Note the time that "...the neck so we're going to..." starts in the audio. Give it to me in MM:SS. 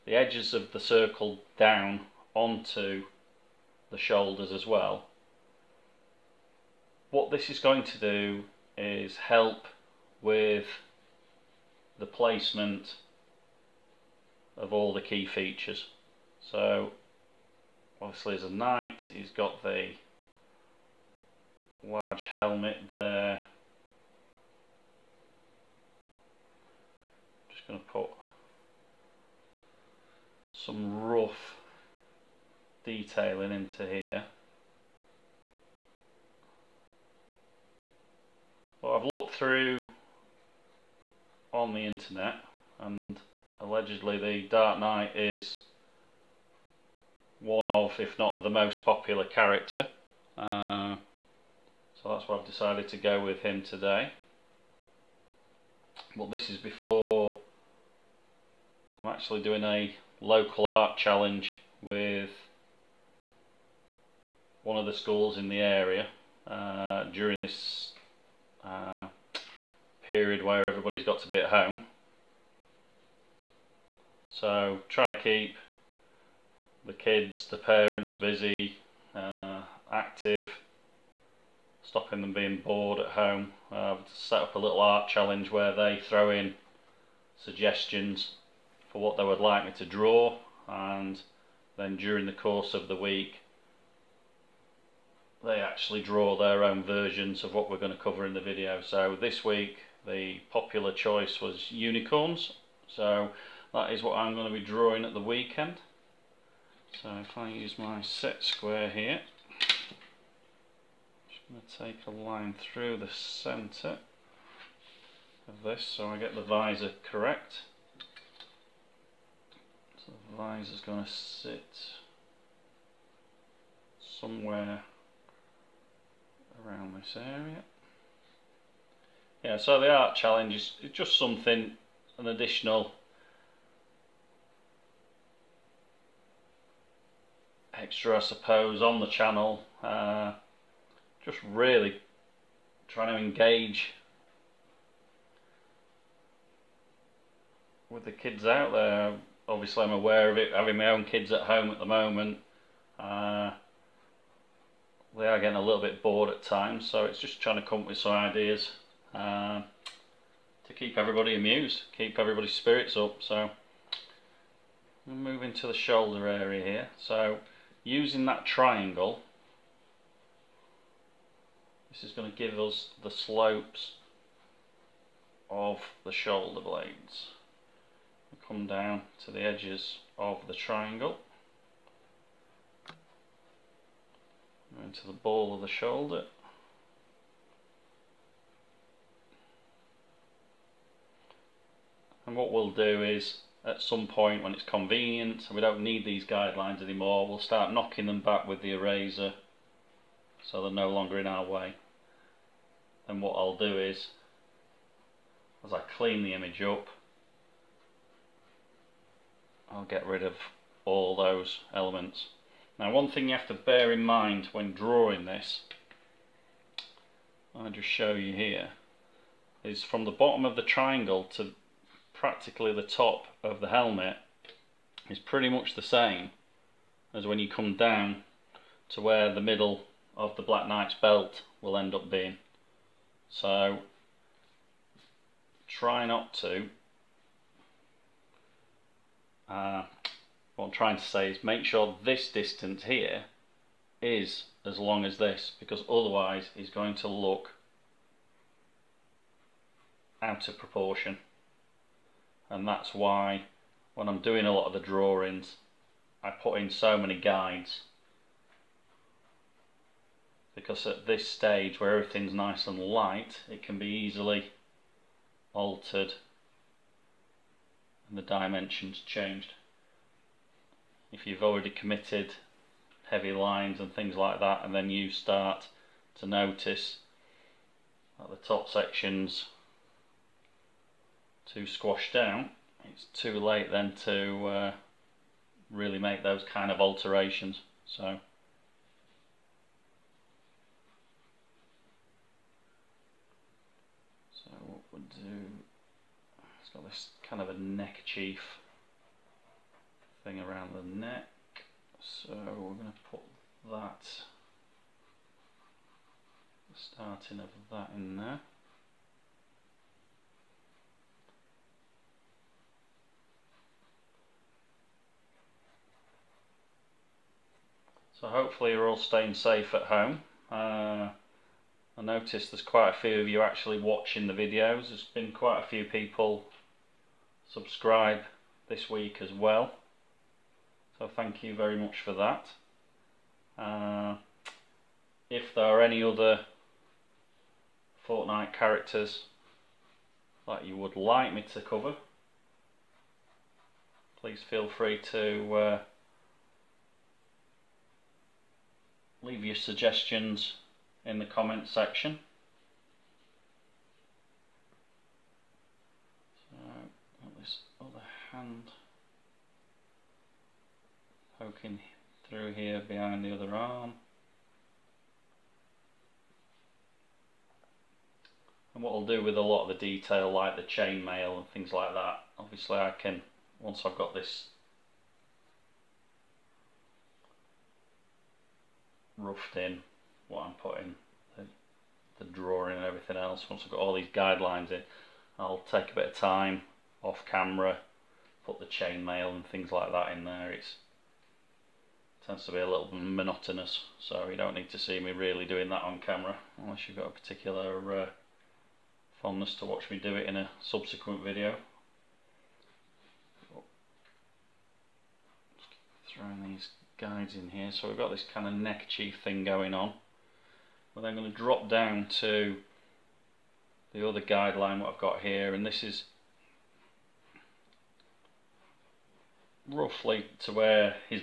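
05:00.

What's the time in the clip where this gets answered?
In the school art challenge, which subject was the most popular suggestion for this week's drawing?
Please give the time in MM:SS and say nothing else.
01:41.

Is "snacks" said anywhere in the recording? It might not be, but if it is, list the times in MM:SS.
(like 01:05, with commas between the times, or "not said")
not said.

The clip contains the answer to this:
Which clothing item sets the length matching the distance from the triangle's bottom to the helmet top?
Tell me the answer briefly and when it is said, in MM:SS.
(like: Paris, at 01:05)
Belt, at 03:50.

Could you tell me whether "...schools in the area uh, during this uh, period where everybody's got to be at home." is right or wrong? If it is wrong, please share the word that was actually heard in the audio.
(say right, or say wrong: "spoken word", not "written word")
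right.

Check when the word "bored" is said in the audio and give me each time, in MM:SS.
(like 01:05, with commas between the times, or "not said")
01:22, 02:36.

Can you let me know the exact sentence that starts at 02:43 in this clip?
So we moving to the shoulder area here.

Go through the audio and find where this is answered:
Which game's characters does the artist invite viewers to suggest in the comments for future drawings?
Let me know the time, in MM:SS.
05:38.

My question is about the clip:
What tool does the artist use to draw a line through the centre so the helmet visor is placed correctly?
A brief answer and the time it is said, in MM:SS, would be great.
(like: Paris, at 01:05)
Set square, at 01:48.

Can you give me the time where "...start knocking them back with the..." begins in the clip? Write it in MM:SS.
03:17.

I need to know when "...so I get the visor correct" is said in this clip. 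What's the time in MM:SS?
01:55.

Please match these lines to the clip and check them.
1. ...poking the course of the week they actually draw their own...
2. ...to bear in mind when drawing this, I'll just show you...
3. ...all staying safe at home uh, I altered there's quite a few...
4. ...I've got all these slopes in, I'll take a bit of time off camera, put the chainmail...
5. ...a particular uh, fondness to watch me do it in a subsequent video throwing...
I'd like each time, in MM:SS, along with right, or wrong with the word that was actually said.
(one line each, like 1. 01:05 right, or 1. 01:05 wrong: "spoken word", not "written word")
1. 01:31 wrong: "during", not "poking"
2. 03:33 right
3. 05:18 wrong: "noticed", not "altered"
4. 06:23 wrong: "guidelines", not "slopes"
5. 06:37 right.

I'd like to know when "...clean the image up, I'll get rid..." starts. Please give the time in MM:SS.
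03:25.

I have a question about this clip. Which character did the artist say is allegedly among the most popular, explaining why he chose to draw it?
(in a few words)
Dark Knight.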